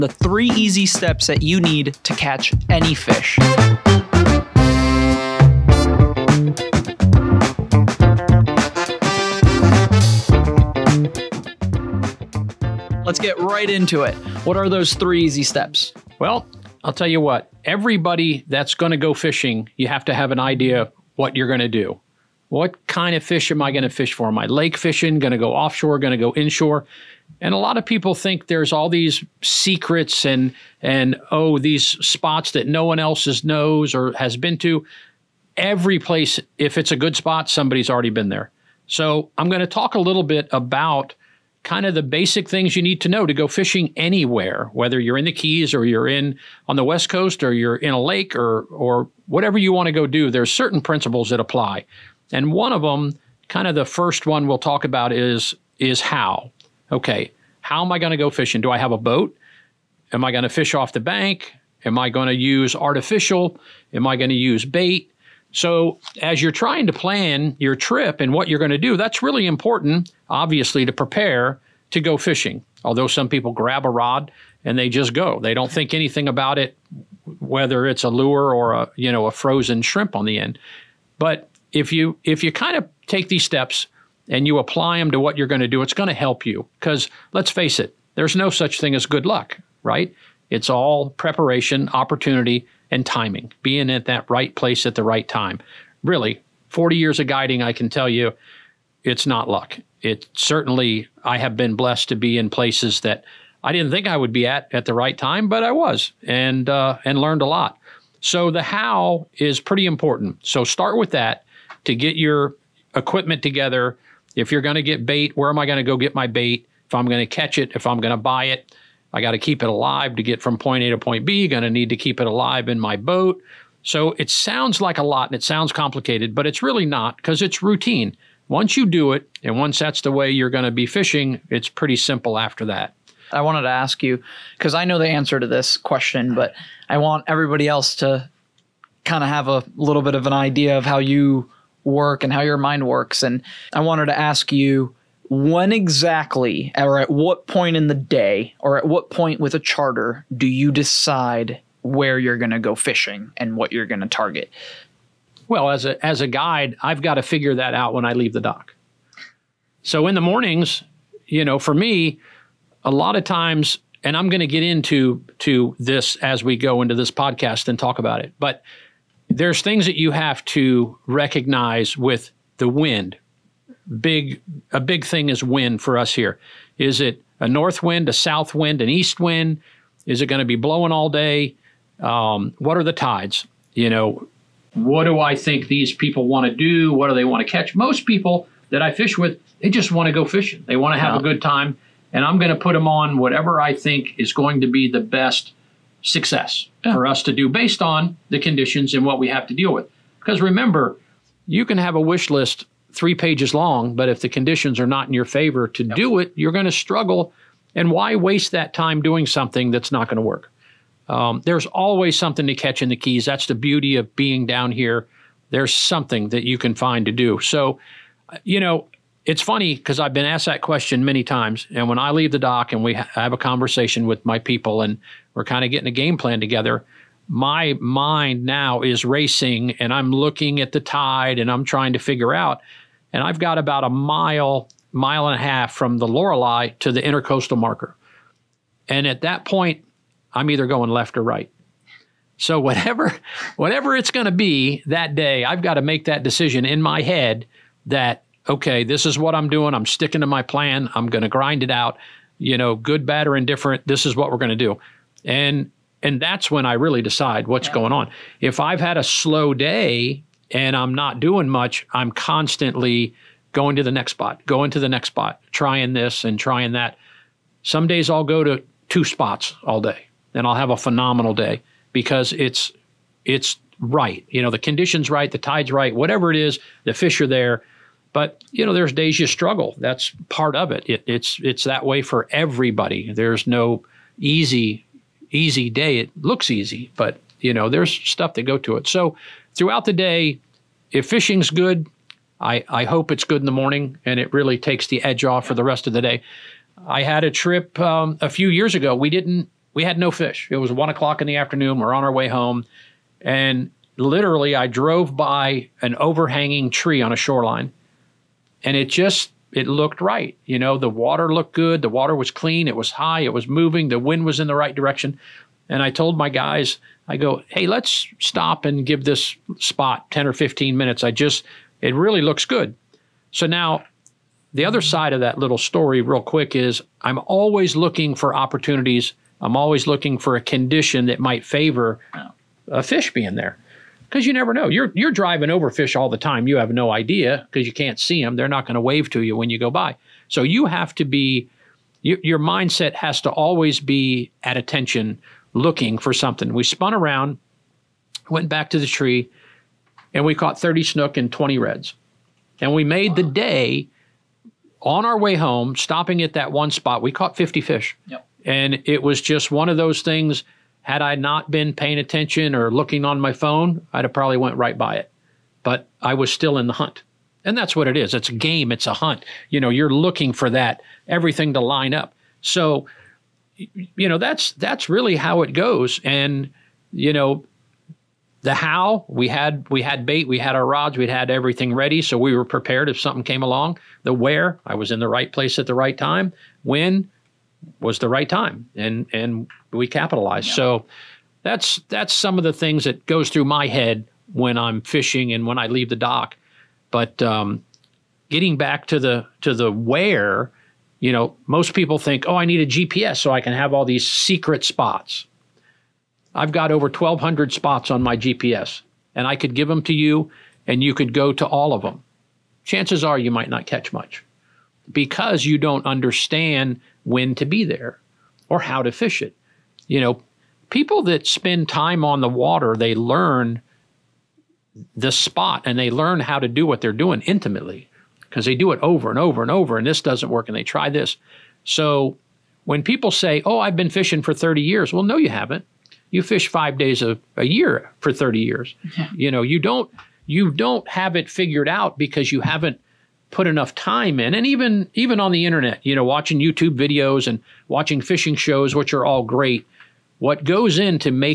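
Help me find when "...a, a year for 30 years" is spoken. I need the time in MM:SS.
07:17.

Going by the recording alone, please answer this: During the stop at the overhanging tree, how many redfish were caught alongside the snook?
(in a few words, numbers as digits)
20.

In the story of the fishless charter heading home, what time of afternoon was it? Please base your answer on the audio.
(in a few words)
1:00.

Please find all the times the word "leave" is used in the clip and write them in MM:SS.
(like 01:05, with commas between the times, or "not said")
02:38, 03:42, 06:35.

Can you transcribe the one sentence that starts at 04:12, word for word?
You know, good, bad, or indifferent.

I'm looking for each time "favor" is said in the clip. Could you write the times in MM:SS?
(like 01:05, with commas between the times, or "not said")
03:25, 05:31.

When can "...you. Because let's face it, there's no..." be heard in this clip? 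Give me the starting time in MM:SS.
01:26.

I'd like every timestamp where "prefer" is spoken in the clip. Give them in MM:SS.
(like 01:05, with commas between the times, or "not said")
not said.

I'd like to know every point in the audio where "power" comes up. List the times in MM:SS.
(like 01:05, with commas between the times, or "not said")
not said.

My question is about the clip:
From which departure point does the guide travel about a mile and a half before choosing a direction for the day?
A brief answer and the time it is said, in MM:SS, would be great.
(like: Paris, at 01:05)
the Lorelei, at 03:55.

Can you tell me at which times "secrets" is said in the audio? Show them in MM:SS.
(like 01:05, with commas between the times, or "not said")
00:29, 06:44.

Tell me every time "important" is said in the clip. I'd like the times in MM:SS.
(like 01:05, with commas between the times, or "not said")
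01:09, 01:49.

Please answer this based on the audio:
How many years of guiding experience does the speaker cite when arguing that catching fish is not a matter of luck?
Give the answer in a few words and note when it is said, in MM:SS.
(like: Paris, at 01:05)
40, at 01:36.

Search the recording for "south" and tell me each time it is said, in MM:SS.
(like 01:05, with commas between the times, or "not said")
02:58.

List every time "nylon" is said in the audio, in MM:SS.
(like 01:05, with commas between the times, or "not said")
not said.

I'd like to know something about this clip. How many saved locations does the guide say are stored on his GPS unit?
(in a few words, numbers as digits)
1,200.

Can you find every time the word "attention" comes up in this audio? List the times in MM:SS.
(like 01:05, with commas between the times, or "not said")
05:44, 06:01.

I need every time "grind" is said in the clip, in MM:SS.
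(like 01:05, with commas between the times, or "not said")
04:11.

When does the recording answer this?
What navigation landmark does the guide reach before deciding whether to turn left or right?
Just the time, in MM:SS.
03:57.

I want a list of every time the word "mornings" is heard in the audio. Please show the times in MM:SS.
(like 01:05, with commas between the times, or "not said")
02:40, 04:53.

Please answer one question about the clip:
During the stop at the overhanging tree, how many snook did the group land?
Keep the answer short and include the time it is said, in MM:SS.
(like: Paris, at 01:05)
30, at 05:50.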